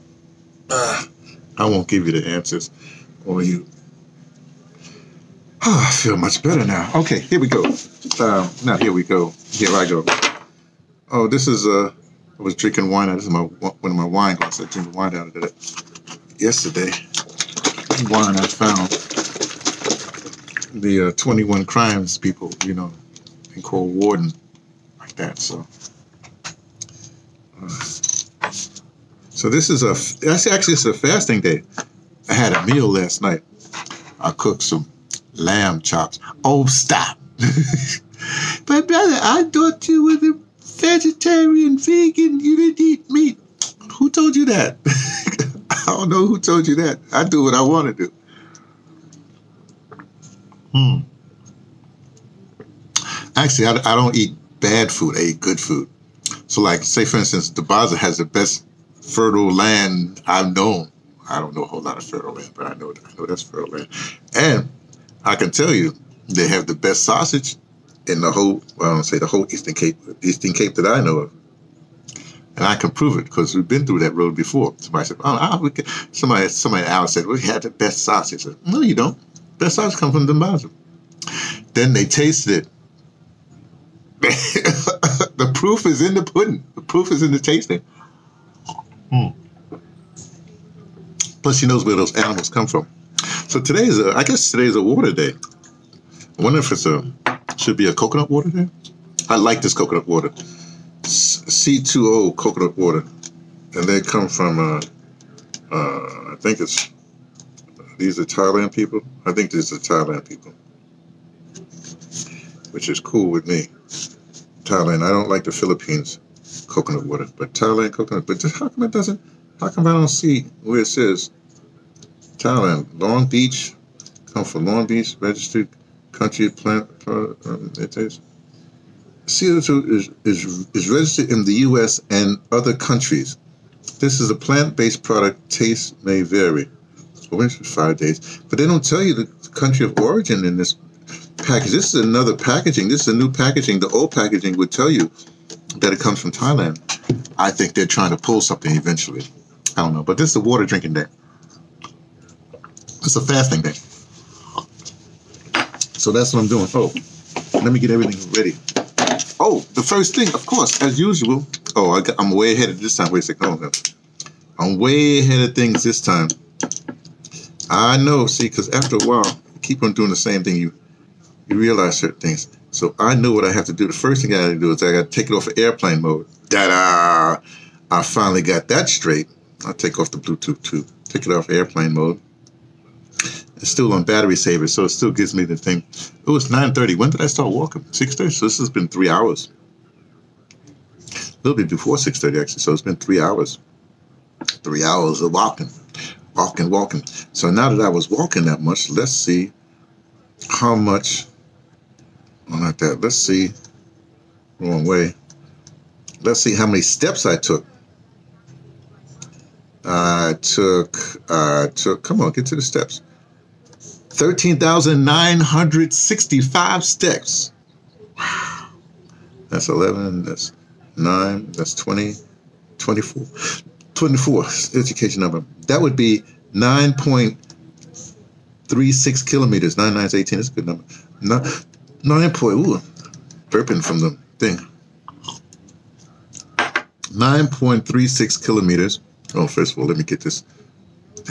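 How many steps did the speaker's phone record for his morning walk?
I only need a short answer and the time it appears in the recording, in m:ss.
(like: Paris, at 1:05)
13,965, at 3:34.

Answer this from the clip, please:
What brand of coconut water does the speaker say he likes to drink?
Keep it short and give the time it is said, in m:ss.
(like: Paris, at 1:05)
C2O, at 1:41.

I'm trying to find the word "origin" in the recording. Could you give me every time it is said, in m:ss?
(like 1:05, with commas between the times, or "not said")
2:19.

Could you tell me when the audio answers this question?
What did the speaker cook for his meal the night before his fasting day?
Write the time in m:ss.
0:35.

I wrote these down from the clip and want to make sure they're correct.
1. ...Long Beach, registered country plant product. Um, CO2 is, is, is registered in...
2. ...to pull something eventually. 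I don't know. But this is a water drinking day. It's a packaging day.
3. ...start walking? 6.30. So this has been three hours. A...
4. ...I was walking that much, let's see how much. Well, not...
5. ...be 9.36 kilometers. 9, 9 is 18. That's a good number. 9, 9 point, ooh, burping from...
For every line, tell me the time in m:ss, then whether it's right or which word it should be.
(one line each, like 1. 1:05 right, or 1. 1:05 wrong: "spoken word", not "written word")
1. 2:04 right
2. 2:28 wrong: "fasting", not "packaging"
3. 3:07 right
4. 3:17 right
5. 3:45 right.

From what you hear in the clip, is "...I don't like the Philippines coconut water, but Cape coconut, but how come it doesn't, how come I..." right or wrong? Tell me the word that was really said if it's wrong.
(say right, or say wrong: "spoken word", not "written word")
wrong: "Thailand", not "Cape".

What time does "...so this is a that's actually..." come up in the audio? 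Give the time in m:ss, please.
0:29.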